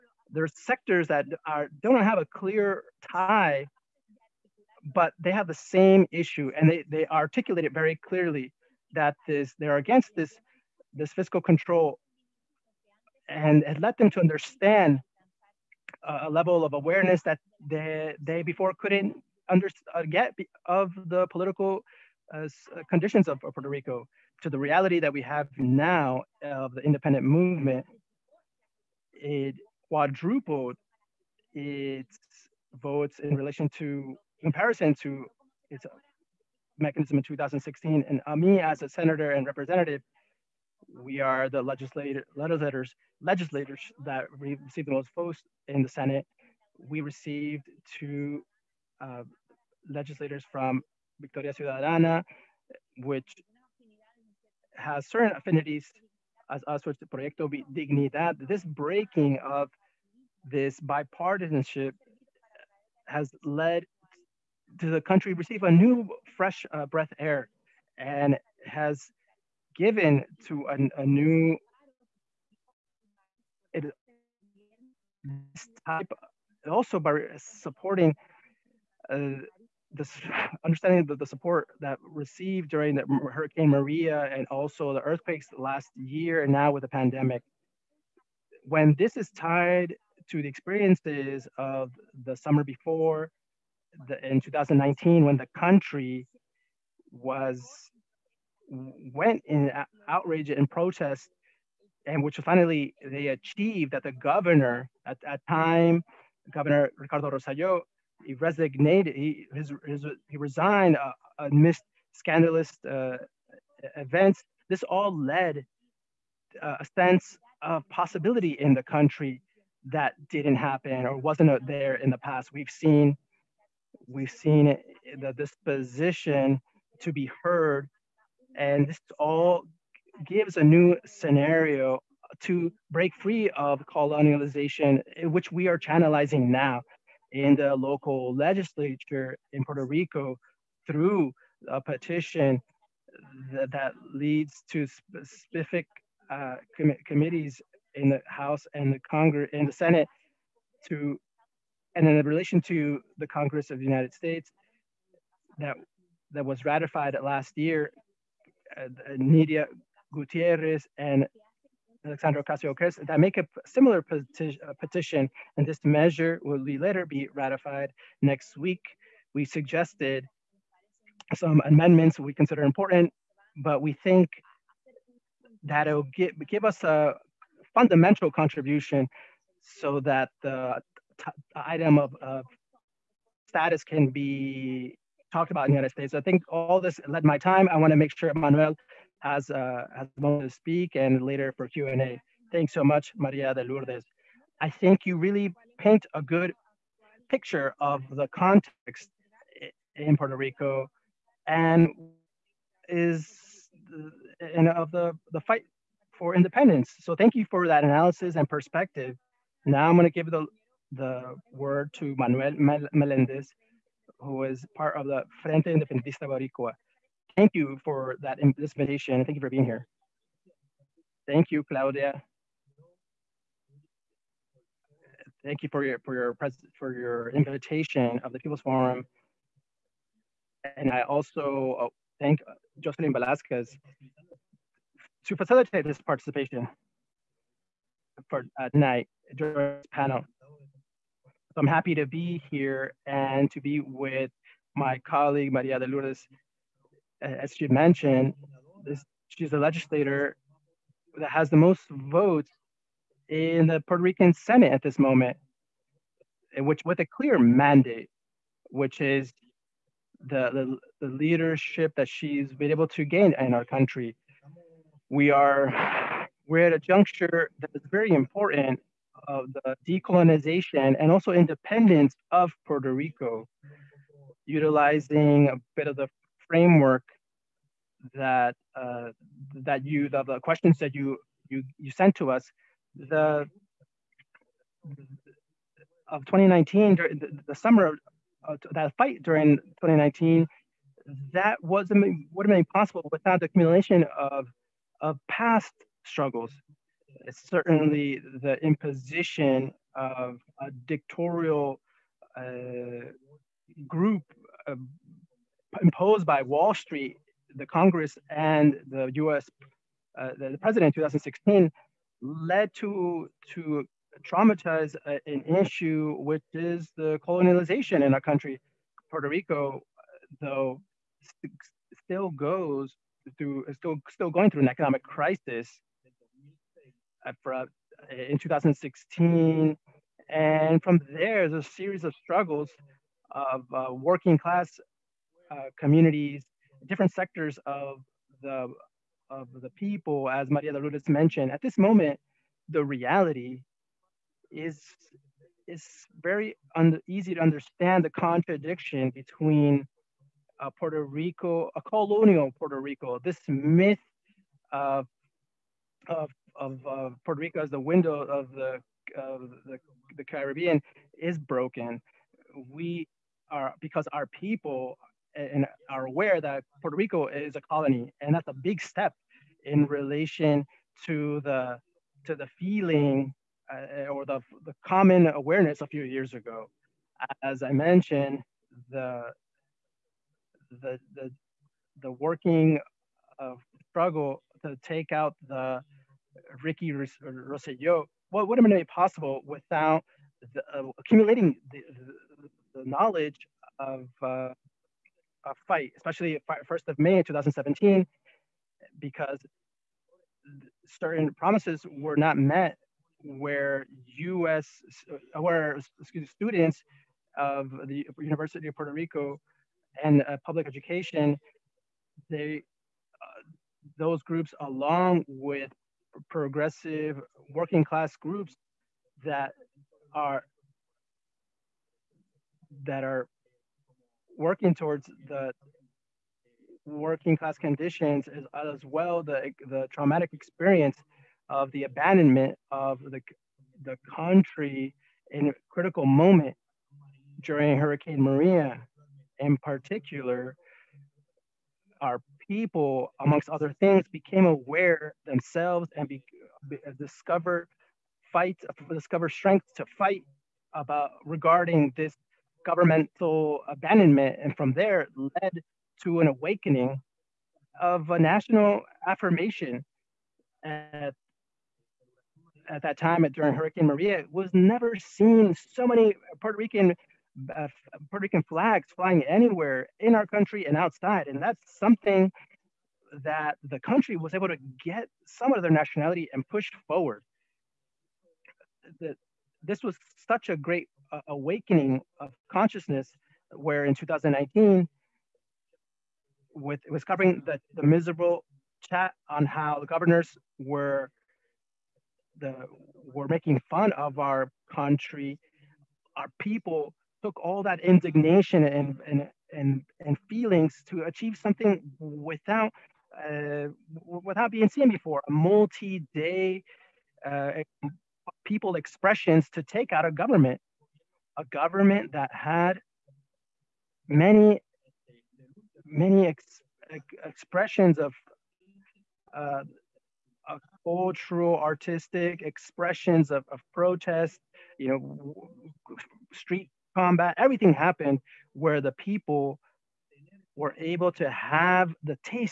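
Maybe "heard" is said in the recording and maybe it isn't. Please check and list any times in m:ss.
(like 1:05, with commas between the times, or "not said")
2:07.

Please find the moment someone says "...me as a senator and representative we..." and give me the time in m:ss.
0:38.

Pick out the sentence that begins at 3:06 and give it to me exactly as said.
I think all this led my time.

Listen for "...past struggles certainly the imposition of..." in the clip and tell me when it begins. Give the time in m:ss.
4:55.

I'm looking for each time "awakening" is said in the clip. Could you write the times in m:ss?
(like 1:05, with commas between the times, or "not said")
7:36, 8:01.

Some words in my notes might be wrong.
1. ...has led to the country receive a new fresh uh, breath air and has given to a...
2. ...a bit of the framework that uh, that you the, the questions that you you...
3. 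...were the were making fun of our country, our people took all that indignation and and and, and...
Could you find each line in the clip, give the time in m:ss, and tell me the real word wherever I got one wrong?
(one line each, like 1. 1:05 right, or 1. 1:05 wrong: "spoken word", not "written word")
1. 1:03 right
2. 4:35 right
3. 8:10 right.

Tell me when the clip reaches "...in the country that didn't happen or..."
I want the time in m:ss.
1:58.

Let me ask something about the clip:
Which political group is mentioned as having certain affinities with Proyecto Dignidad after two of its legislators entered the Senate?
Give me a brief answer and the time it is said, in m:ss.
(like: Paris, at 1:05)
Victoria Ciudadana, at 0:51.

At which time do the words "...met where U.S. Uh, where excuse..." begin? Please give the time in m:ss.
6:42.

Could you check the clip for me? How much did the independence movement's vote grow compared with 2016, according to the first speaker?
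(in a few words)
Quadrupled.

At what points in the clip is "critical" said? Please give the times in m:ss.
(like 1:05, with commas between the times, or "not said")
7:15.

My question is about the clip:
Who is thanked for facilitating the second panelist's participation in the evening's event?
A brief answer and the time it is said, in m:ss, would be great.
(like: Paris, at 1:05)
Jocelyn Velasquez, at 3:52.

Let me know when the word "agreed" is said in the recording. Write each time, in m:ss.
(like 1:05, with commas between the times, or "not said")
not said.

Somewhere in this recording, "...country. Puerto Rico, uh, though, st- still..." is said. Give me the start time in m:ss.
5:18.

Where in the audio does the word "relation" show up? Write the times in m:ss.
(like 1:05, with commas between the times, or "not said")
0:33, 2:32, 6:09.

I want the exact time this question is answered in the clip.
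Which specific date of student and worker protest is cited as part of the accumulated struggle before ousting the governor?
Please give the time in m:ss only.
6:36.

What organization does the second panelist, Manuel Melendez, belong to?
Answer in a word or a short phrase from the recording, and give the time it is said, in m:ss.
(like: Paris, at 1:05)
Frente Independentista Boricua, at 3:35.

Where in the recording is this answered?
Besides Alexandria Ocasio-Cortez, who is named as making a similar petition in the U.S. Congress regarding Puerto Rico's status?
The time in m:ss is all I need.
2:39.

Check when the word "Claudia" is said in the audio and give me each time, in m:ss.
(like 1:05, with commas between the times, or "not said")
3:41.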